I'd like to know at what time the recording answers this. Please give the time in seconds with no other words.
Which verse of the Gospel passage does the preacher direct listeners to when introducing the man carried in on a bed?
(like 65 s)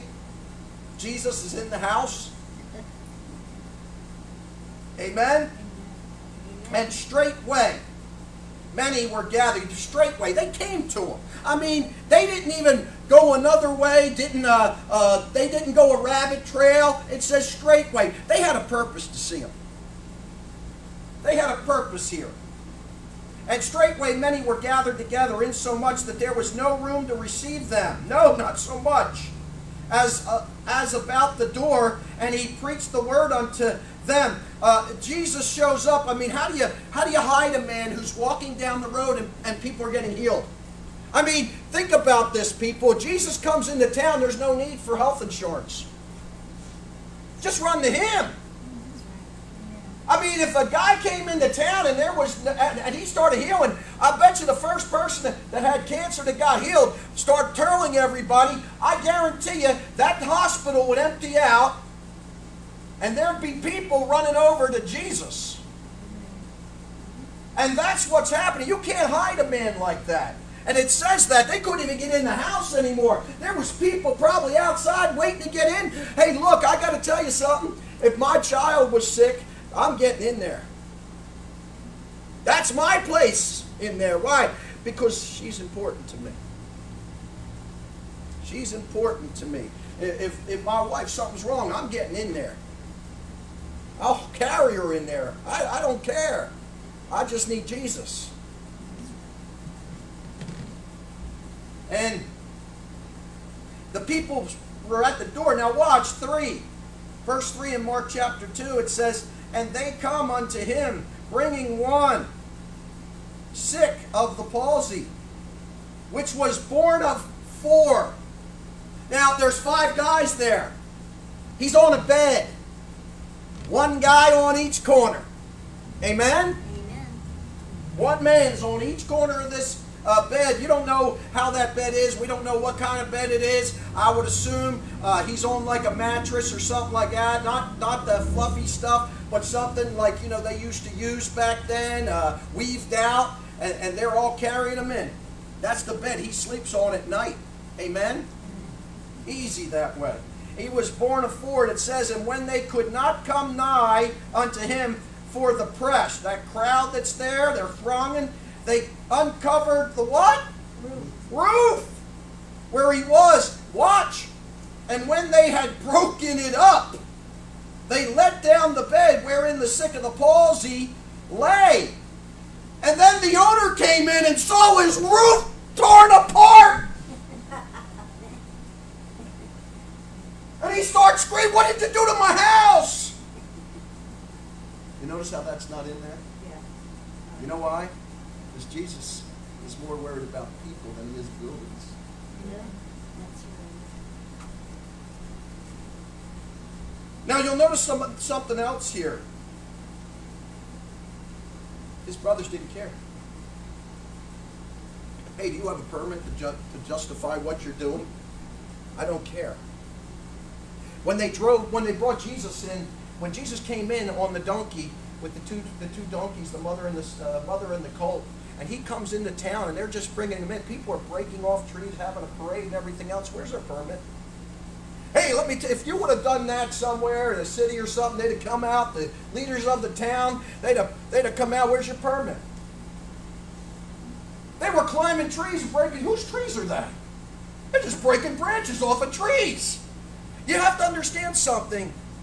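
107 s.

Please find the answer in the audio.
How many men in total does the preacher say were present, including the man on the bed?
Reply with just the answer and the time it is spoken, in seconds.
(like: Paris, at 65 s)
5, at 119 s.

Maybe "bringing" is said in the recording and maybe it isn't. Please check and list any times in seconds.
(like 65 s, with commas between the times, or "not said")
111 s, 220 s.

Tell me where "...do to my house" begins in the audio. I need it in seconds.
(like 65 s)
181 s.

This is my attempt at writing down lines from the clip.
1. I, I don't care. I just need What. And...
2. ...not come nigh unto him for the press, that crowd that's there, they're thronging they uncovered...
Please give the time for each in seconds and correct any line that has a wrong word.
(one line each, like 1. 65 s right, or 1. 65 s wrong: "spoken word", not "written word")
1. 95 s wrong: "Jesus", not "What"
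2. 152 s right.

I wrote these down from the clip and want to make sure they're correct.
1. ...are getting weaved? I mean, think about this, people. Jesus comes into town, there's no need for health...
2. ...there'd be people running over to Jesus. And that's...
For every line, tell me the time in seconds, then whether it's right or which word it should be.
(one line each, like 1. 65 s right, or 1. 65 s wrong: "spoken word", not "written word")
1. 39 s wrong: "healed", not "weaved"
2. 63 s right.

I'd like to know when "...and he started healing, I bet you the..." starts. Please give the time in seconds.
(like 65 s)
52 s.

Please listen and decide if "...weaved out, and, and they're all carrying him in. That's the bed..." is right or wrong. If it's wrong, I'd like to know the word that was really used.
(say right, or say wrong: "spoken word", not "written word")
right.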